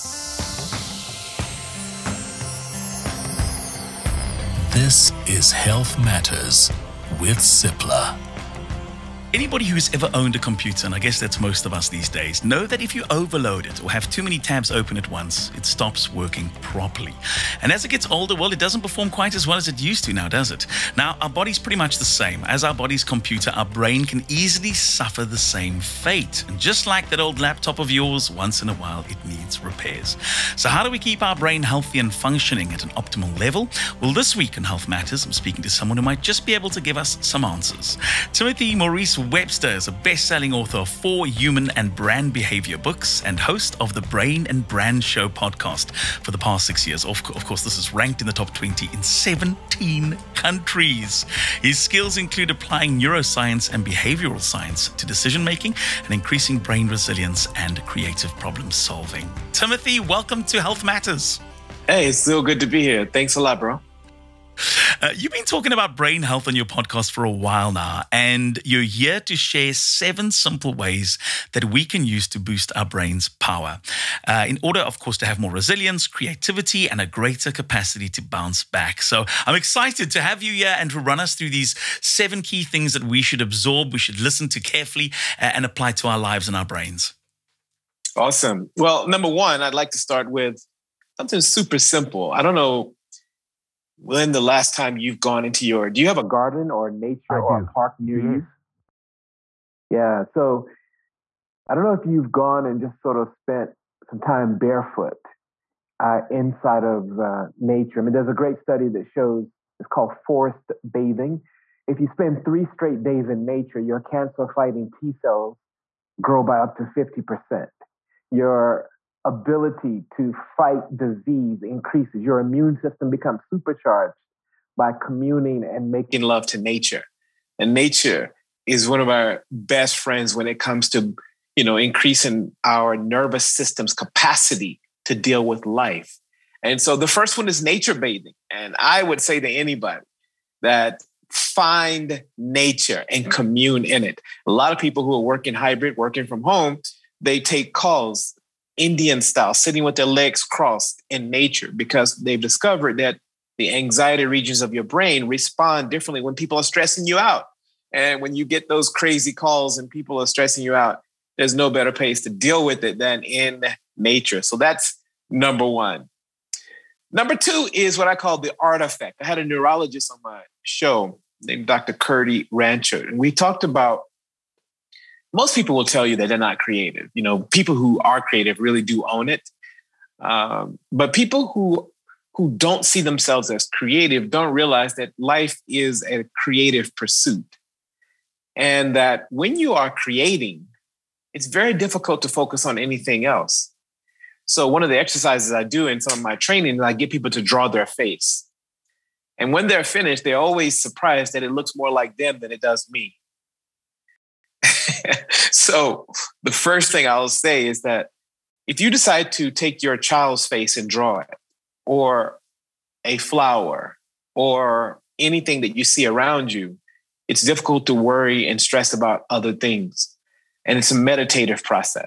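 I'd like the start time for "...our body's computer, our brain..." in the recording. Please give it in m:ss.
0:22.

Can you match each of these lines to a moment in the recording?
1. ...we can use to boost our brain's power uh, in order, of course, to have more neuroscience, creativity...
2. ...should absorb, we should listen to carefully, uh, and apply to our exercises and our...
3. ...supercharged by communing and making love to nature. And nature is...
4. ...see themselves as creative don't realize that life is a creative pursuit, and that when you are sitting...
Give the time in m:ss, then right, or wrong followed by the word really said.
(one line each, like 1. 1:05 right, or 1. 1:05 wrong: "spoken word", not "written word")
1. 1:11 wrong: "resilience", not "neuroscience"
2. 1:23 wrong: "lives", not "exercises"
3. 2:03 right
4. 3:02 wrong: "creating", not "sitting".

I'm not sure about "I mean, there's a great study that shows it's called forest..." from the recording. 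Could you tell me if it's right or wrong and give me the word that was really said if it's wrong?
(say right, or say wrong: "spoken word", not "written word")
right.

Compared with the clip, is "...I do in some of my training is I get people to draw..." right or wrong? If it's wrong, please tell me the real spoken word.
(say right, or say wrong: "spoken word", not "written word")
right.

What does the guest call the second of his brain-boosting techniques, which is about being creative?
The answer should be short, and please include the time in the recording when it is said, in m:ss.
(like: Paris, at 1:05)
the artifact, at 2:48.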